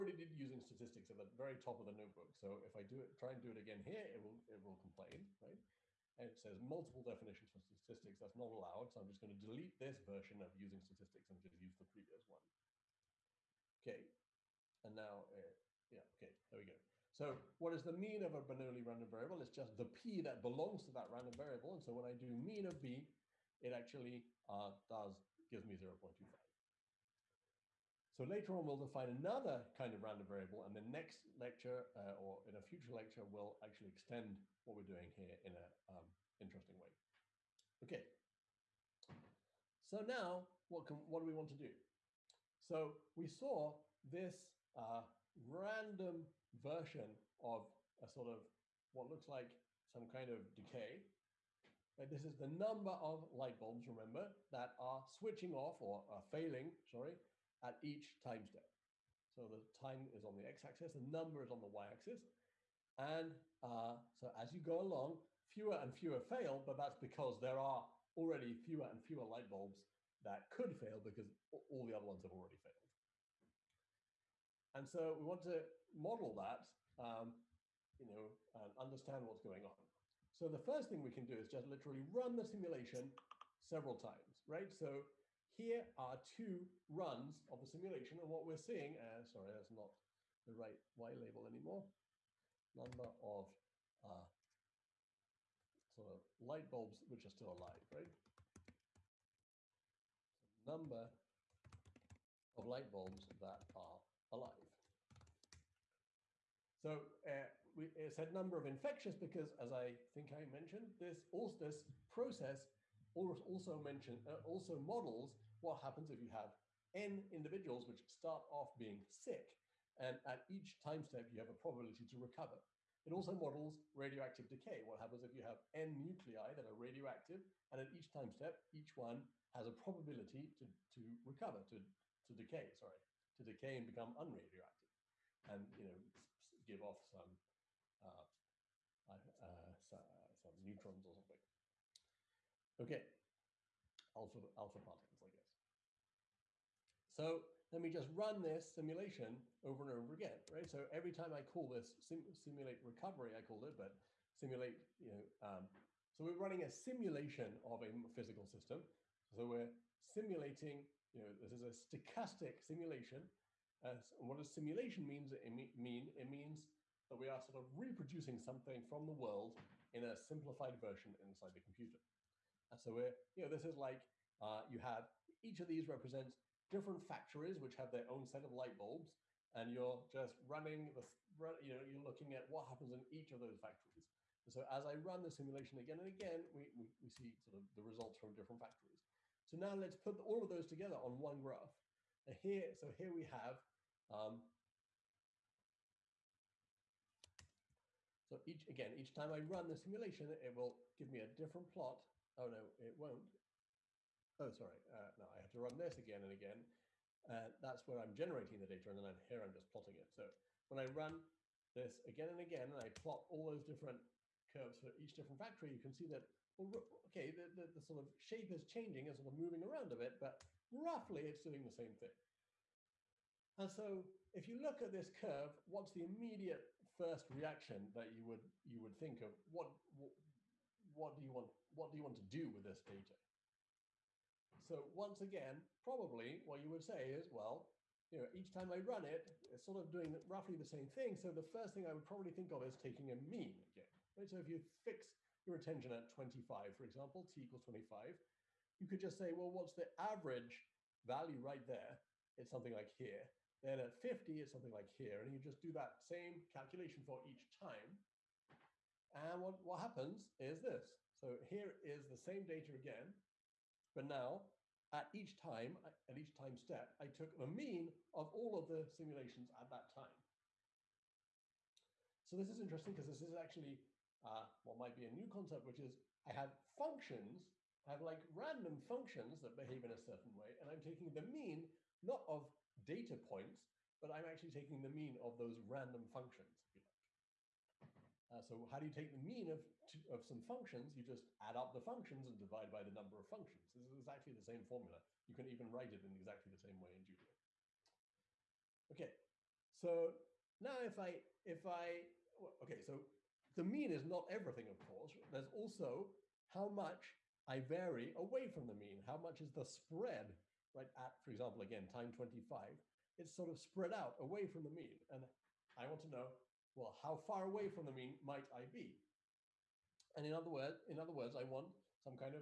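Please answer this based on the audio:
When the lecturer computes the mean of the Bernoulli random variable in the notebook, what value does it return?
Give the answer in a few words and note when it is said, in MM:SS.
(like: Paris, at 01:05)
0.25, at 00:25.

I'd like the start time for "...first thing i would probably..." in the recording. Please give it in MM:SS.
04:01.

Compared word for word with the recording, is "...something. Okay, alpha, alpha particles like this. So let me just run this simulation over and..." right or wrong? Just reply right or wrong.
right.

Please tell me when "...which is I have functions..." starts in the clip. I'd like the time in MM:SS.
04:35.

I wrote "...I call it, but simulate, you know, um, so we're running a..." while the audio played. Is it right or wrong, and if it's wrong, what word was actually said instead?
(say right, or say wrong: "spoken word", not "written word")
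right.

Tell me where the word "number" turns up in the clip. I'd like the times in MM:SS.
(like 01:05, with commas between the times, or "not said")
00:52, 01:01, 01:32, 01:40, 01:48, 04:52.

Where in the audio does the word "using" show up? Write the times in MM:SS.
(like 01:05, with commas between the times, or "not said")
00:00, 00:10.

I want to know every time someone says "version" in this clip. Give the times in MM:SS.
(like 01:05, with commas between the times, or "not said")
00:09, 00:46, 02:50.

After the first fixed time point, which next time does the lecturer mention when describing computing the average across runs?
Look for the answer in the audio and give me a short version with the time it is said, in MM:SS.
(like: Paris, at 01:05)
50, at 04:13.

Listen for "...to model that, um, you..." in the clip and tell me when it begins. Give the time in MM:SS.
01:15.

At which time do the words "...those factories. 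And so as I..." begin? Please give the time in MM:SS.
03:03.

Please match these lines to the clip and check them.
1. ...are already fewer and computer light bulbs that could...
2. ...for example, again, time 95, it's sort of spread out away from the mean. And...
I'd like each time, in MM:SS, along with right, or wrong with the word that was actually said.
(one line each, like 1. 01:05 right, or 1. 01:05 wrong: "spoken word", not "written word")
1. 01:07 wrong: "fewer", not "computer"
2. 05:11 wrong: "25", not "95".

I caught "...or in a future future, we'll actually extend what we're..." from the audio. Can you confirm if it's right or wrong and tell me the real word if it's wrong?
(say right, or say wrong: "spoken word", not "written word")
wrong: "lecture", not "future".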